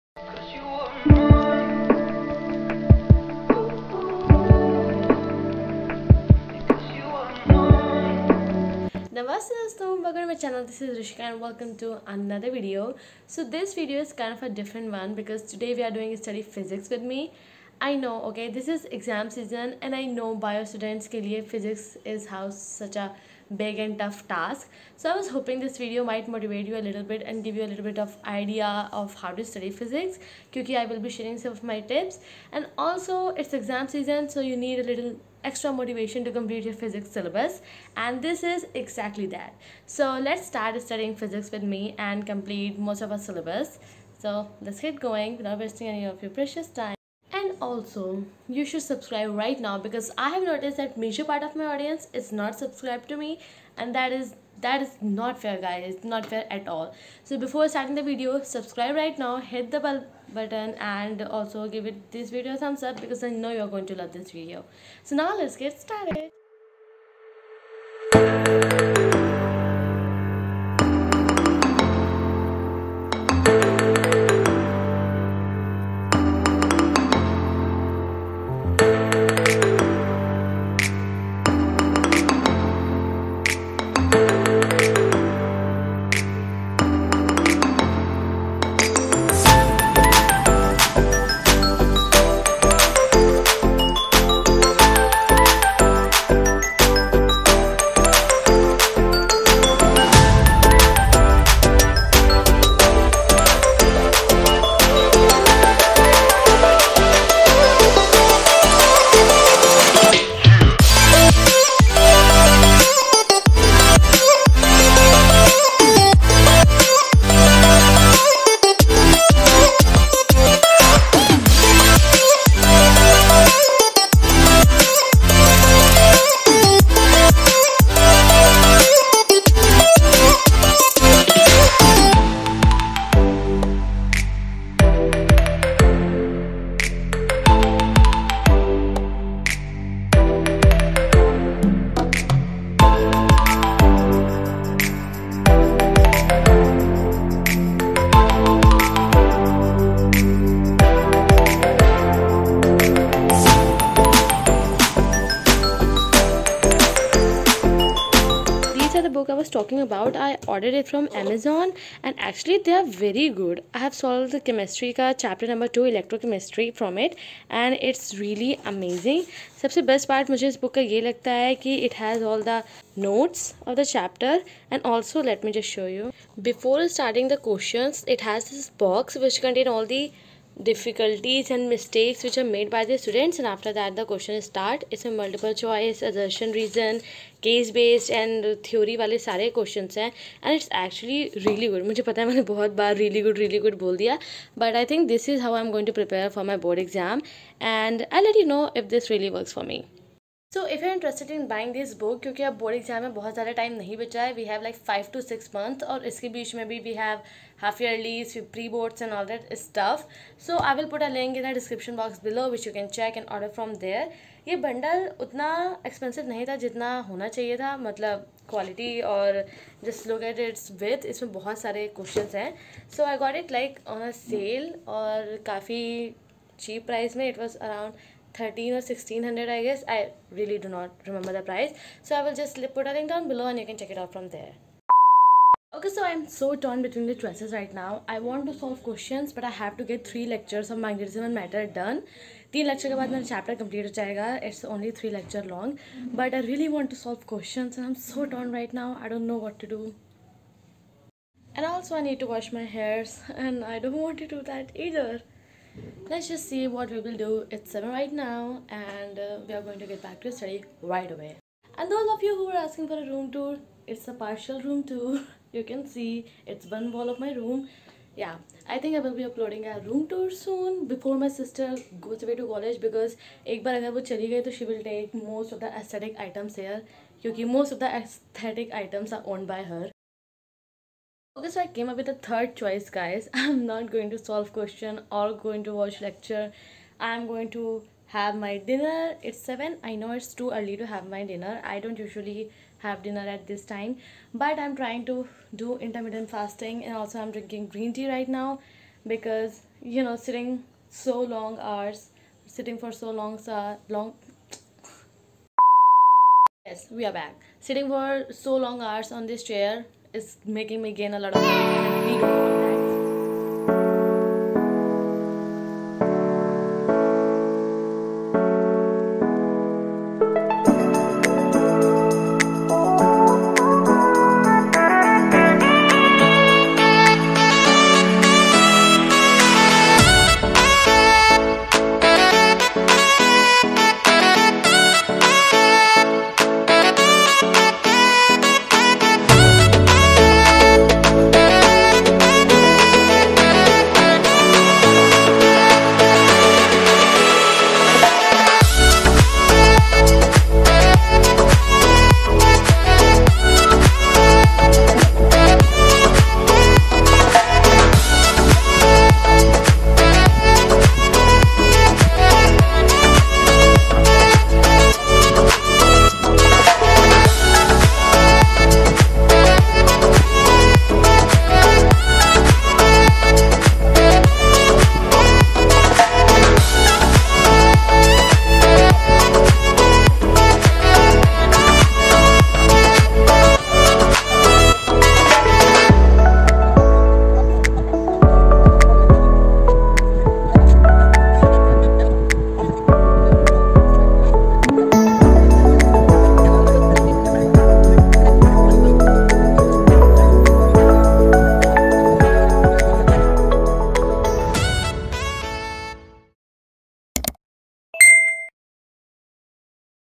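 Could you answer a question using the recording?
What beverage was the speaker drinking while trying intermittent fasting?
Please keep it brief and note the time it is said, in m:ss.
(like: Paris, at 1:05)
Green tea, at 4:57.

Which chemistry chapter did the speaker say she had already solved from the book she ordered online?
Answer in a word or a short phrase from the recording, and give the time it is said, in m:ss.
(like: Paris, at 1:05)
Electrochemistry, at 2:45.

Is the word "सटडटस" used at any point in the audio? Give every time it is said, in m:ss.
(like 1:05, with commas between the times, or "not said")
0:20.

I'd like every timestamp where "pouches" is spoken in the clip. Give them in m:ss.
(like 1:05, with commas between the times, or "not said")
not said.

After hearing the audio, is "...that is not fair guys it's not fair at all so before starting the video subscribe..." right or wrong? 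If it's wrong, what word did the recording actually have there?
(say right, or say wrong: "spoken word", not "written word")
right.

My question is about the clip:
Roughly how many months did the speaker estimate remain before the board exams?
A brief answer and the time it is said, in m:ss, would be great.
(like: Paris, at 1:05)
5 to 6 months, at 3:24.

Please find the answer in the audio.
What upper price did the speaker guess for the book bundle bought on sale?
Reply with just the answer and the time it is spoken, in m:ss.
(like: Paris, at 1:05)
1600, at 3:48.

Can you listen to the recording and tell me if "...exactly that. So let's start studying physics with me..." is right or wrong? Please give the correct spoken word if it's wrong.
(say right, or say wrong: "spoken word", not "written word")
right.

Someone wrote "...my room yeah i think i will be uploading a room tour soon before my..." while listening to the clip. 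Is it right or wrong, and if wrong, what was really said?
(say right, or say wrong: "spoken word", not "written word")
right.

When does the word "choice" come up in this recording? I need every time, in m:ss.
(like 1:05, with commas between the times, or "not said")
3:05, 3:57, 4:42.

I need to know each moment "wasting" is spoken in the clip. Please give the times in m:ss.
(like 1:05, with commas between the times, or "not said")
0:45.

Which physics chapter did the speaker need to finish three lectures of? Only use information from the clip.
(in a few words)
Magnetism and matter.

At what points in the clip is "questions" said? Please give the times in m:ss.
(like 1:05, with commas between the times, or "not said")
2:57, 3:04, 3:09, 3:58, 4:07, 4:44.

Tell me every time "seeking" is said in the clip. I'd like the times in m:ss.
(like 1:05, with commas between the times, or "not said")
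not said.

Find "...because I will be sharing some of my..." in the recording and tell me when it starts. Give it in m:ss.
0:30.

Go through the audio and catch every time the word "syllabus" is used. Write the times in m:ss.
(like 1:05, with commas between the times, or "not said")
0:37, 0:43.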